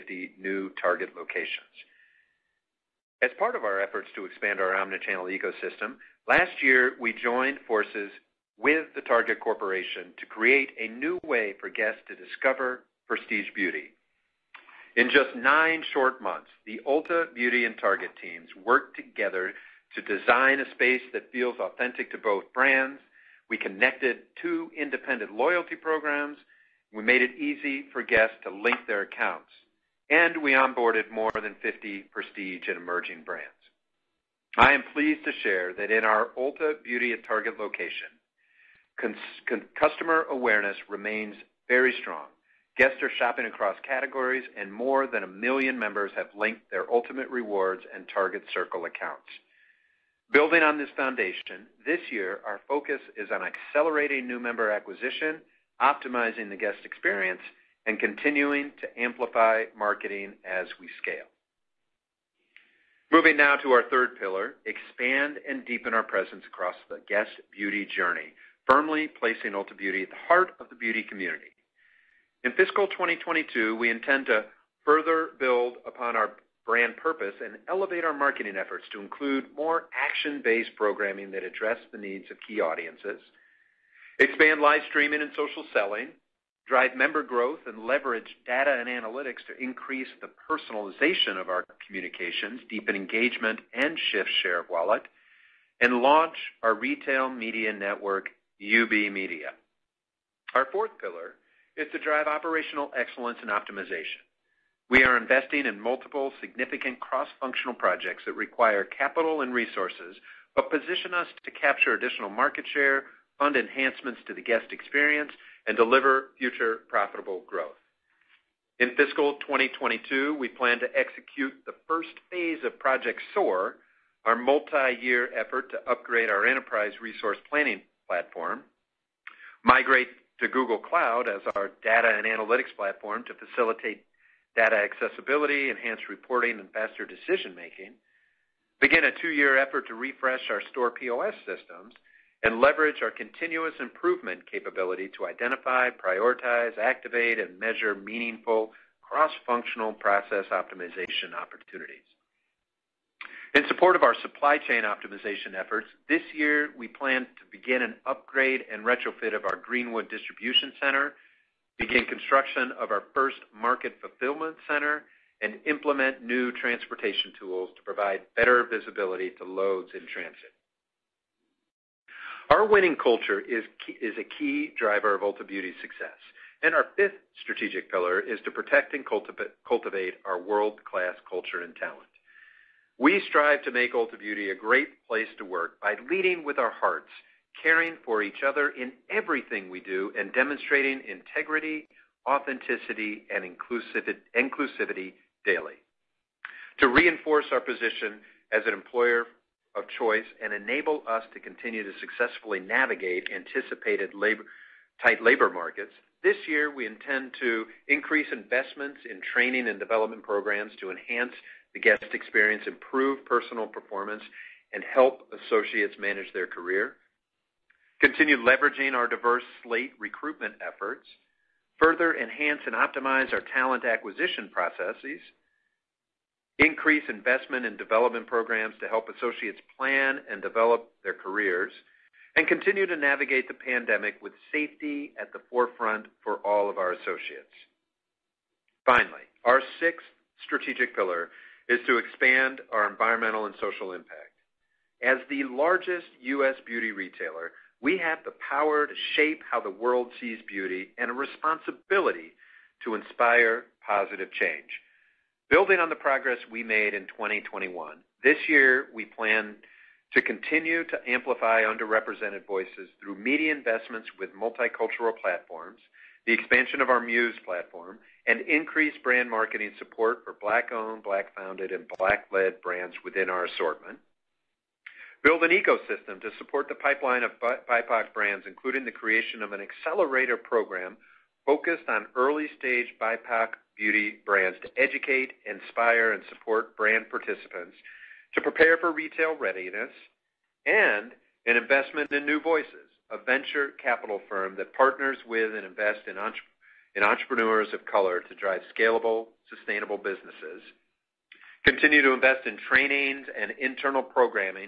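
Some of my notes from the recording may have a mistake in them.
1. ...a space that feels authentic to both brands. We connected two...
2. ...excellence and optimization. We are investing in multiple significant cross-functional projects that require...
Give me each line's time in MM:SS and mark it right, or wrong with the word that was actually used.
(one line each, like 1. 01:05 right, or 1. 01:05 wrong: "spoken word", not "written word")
1. 00:20 right
2. 01:42 right.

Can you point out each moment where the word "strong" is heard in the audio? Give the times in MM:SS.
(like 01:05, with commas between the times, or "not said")
00:42.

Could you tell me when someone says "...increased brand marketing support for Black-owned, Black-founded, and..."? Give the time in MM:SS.
04:28.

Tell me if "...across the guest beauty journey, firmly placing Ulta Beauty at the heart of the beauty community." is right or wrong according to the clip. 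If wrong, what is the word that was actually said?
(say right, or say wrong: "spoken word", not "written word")
right.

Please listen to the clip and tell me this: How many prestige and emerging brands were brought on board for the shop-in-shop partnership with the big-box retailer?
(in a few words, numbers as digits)
more than 50.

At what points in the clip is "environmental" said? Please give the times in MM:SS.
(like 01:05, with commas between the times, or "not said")
04:02.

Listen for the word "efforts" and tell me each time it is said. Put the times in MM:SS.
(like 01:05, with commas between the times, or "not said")
00:03, 01:18, 02:05, 02:19, 02:35, 03:40.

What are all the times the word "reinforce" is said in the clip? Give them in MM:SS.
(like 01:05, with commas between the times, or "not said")
03:16.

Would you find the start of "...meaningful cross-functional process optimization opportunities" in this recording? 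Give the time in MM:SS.
02:27.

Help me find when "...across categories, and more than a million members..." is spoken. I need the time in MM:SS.
00:43.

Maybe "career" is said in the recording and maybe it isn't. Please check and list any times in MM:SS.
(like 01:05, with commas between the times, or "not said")
03:36, 03:51.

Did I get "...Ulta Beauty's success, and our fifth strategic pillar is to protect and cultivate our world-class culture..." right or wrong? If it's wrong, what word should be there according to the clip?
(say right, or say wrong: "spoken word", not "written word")
right.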